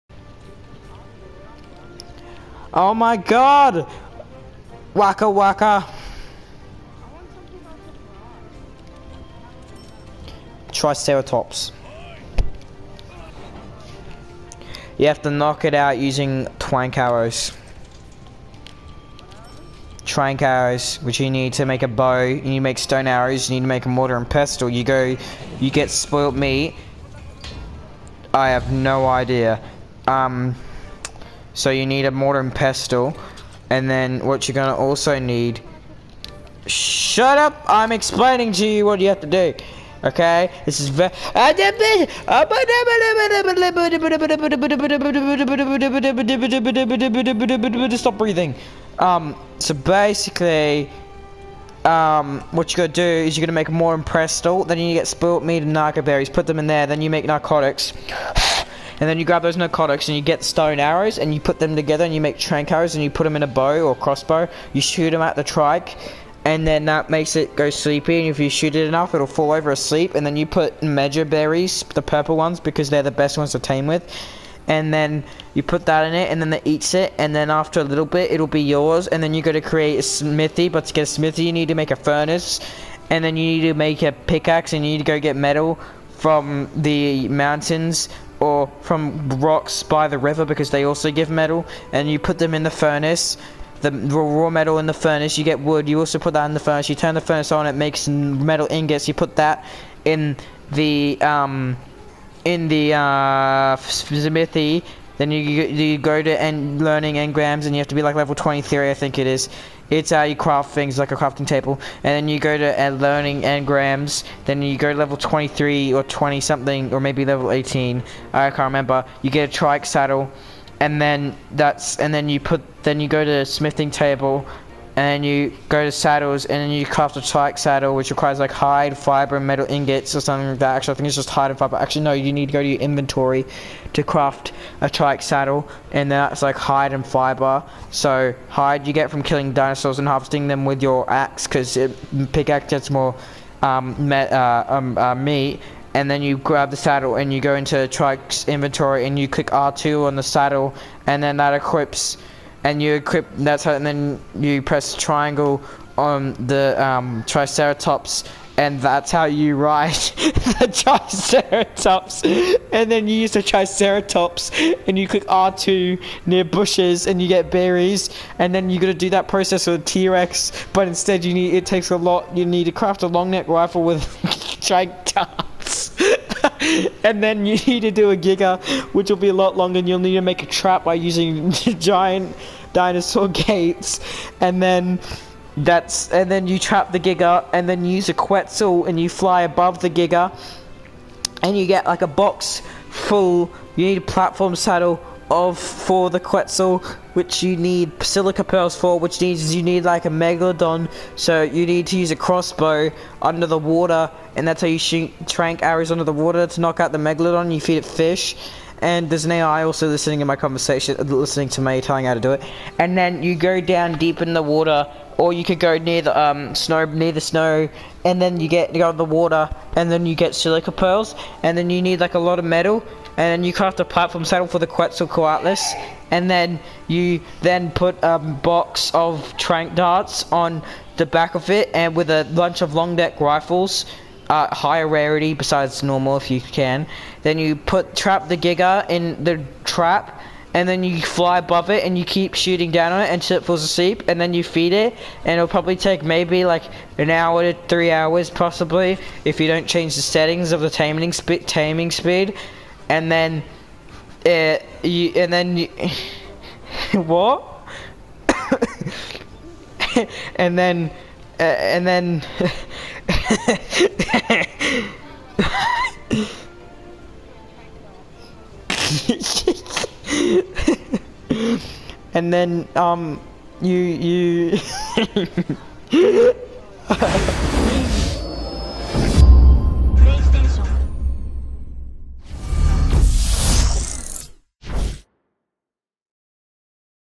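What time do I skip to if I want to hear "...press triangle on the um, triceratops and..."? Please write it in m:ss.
2:34.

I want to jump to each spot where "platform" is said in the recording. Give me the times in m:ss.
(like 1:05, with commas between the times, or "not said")
3:14, 3:43.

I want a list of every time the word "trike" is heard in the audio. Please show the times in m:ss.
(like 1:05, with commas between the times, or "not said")
1:05, 1:59, 2:07, 2:14, 2:27.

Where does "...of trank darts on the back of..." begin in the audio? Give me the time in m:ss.
3:48.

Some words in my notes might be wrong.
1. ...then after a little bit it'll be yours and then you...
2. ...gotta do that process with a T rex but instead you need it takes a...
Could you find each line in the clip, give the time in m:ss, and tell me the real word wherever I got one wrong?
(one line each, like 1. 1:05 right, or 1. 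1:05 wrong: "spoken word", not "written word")
1. 1:17 right
2. 2:48 right.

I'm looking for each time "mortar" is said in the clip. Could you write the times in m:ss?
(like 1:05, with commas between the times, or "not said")
0:23, 0:32.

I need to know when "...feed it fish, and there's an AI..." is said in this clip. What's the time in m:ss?
3:27.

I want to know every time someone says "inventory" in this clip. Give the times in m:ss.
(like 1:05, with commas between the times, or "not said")
2:12, 2:28.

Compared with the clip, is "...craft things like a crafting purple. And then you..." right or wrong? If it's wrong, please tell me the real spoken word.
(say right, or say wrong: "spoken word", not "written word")
wrong: "table", not "purple".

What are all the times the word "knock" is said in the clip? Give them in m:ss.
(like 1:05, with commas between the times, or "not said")
0:15, 3:26.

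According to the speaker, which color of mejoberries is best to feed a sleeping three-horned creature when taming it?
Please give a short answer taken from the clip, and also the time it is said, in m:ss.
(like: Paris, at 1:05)
purple, at 1:11.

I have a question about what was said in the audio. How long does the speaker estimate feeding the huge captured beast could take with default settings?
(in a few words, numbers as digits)
1 to 3 hours.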